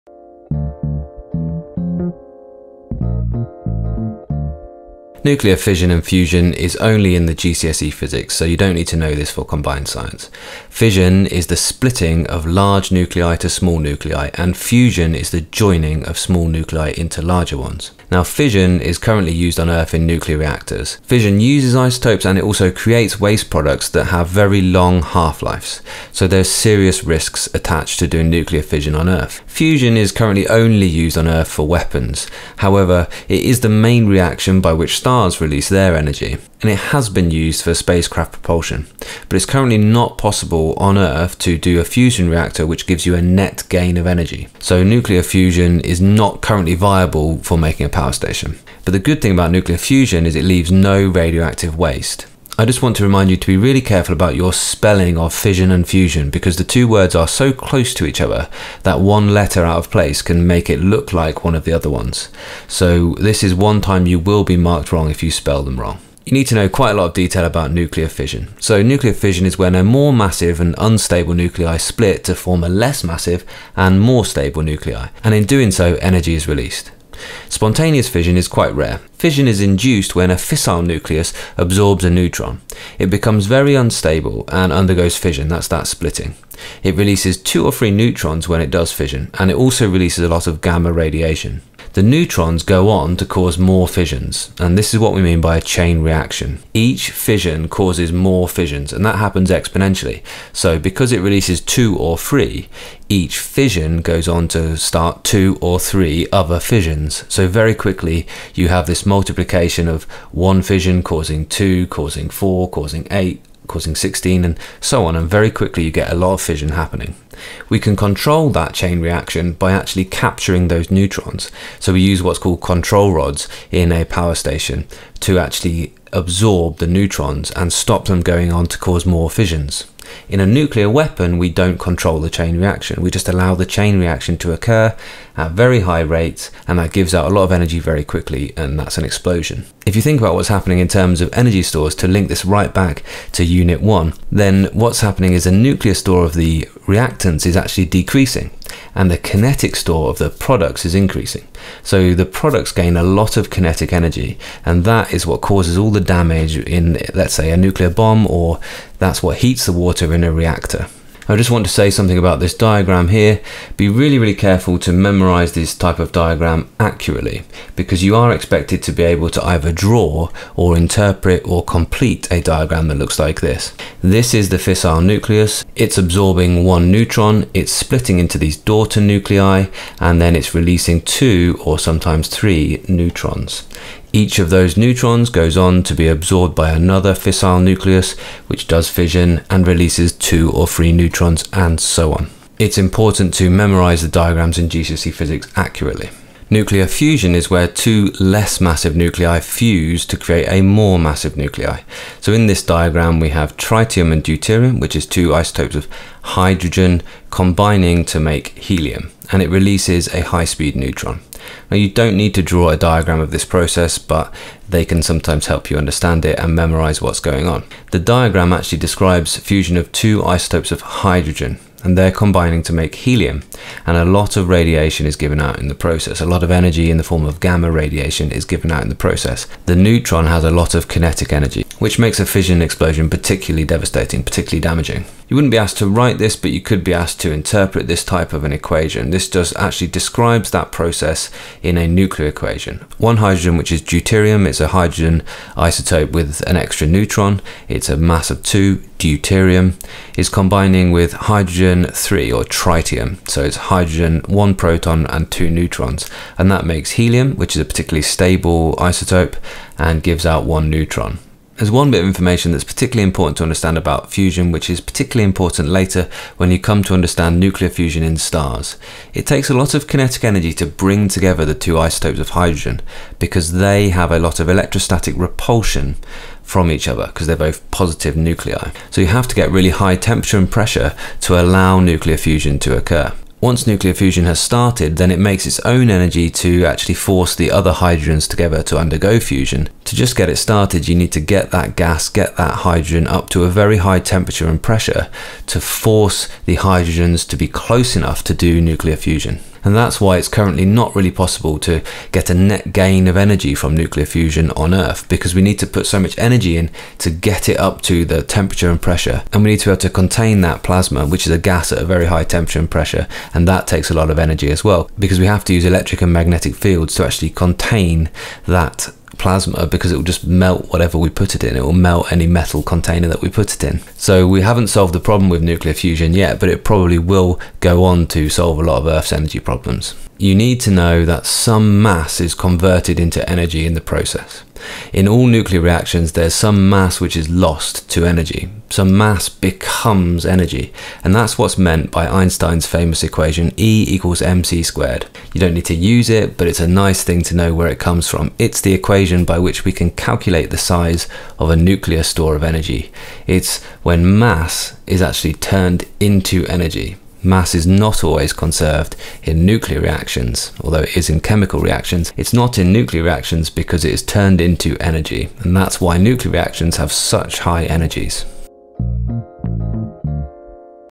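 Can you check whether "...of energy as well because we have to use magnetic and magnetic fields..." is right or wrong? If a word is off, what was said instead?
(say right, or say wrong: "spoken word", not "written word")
wrong: "electric", not "magnetic".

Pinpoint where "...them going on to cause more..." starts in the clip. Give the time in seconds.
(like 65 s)
128 s.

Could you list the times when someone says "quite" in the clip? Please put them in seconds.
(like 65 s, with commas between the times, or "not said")
66 s, 78 s.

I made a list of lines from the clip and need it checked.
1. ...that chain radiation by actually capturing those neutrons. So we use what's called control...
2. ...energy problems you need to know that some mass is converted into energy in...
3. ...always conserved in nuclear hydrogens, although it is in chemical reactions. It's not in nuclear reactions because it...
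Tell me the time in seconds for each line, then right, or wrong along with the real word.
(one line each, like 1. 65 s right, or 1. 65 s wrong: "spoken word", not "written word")
1. 118 s wrong: "reaction", not "radiation"
2. 329 s right
3. 358 s wrong: "reactions", not "hydrogens".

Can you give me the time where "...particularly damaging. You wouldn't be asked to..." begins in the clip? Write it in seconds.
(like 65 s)
234 s.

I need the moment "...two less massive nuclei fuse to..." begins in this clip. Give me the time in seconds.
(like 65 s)
197 s.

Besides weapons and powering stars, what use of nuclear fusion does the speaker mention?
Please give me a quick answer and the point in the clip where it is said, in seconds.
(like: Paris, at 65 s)
spacecraft propulsion, at 37 s.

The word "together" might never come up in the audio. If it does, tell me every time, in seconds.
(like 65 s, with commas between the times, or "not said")
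271 s, 288 s.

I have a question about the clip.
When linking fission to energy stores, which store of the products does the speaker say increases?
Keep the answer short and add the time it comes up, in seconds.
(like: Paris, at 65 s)
kinetic store, at 149 s.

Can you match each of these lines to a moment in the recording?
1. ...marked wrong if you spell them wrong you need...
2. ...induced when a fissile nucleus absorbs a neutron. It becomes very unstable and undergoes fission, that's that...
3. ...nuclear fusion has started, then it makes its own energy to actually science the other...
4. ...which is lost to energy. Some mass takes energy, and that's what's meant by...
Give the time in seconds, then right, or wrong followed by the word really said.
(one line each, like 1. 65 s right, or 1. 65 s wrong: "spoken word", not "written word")
1. 64 s right
2. 79 s right
3. 283 s wrong: "force", not "science"
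4. 337 s wrong: "becomes", not "takes".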